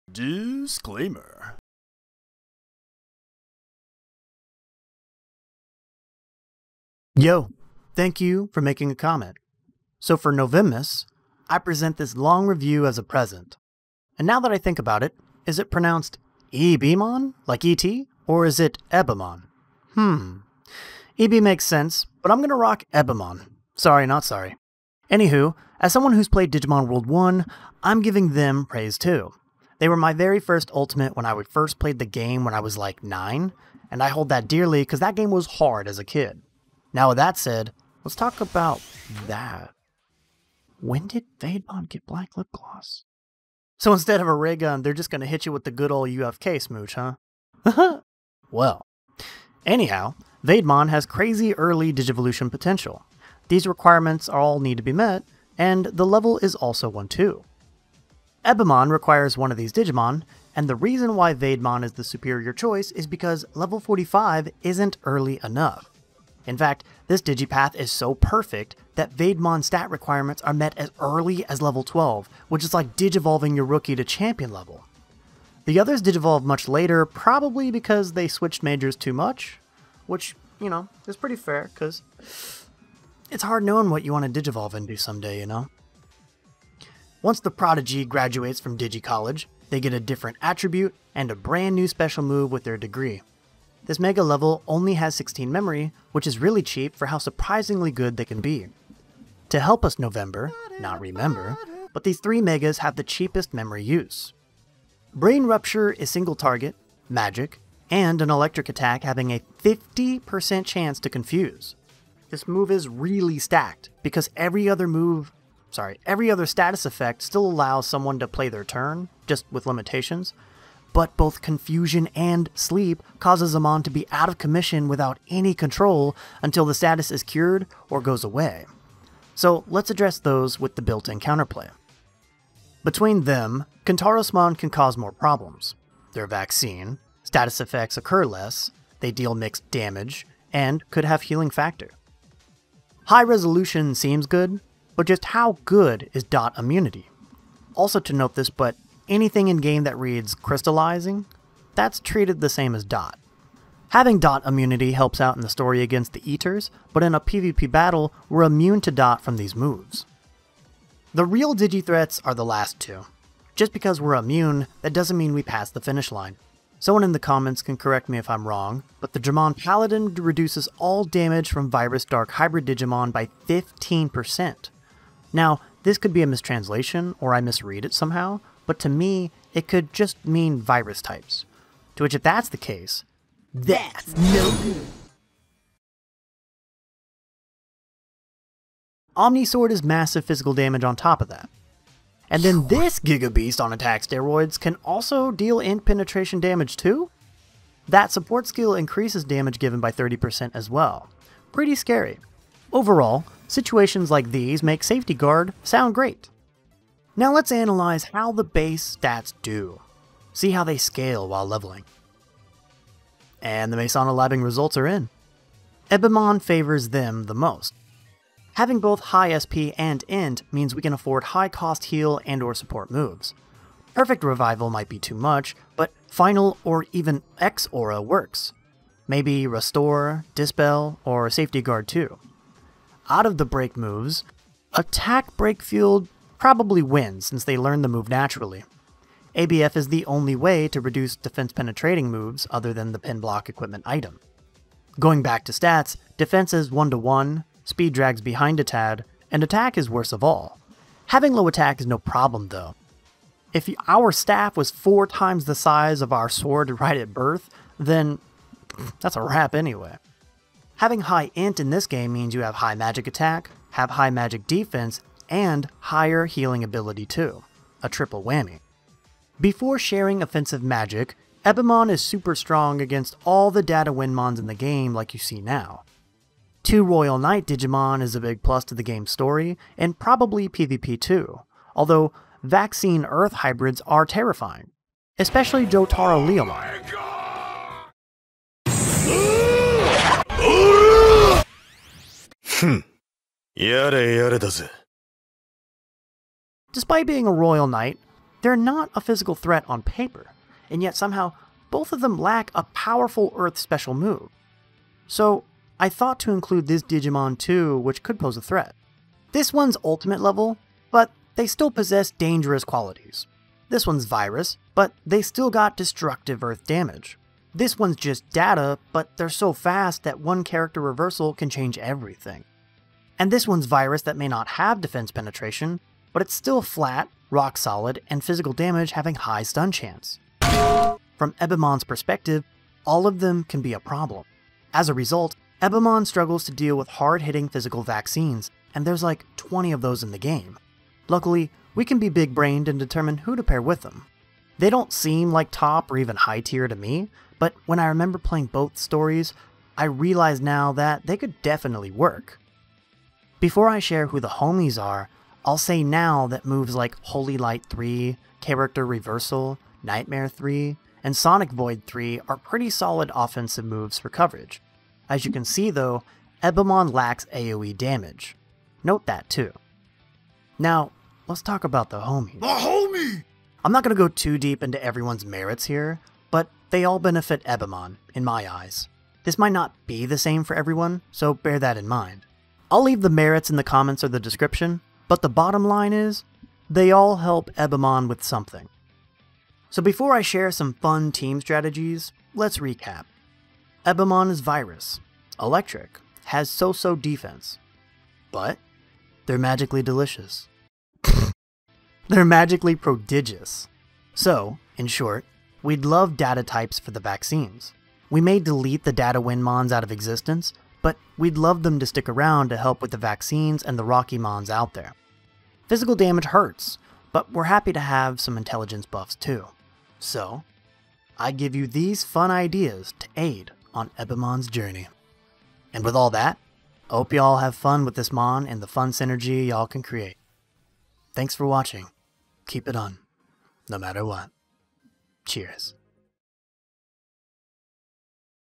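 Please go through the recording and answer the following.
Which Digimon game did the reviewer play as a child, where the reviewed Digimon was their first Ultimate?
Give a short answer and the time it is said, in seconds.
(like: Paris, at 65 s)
Digimon World 1, at 26 s.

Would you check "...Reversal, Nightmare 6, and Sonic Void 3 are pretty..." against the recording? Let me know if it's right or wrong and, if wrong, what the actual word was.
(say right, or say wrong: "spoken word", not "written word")
wrong: "3", not "6".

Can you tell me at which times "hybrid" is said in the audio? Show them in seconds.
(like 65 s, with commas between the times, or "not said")
172 s, 283 s.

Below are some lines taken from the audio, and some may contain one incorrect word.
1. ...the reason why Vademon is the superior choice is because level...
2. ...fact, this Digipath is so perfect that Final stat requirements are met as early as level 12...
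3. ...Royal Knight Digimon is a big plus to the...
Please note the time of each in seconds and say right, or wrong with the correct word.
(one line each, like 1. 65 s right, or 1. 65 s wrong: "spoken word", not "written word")
1. 60 s right
2. 66 s wrong: "Vademon", not "Final"
3. 276 s right.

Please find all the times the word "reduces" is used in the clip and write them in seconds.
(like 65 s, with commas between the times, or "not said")
170 s, 240 s.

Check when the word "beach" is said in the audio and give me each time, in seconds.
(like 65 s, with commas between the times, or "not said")
not said.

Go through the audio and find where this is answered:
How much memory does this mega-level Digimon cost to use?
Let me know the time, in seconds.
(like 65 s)
95 s.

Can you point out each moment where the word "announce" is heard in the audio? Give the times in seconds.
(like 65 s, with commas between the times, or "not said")
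not said.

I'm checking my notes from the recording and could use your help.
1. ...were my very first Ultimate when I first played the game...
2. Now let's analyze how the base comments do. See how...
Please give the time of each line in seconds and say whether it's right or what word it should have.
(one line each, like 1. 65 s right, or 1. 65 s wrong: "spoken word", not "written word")
1. 29 s right
2. 207 s wrong: "stats", not "comments".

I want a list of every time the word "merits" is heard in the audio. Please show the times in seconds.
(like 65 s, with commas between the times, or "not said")
375 s, 383 s.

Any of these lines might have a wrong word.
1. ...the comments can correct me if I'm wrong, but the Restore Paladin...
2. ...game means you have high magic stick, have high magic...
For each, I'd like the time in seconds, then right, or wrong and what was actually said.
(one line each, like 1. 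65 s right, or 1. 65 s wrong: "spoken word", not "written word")
1. 167 s wrong: "Dramon", not "Restore"
2. 261 s wrong: "attack", not "stick".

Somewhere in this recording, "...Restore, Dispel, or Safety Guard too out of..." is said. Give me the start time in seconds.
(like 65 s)
229 s.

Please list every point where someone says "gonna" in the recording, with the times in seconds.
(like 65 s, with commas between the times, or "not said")
22 s.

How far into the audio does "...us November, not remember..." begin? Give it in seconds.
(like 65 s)
99 s.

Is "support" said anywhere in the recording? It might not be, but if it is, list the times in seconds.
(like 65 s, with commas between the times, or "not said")
198 s, 222 s.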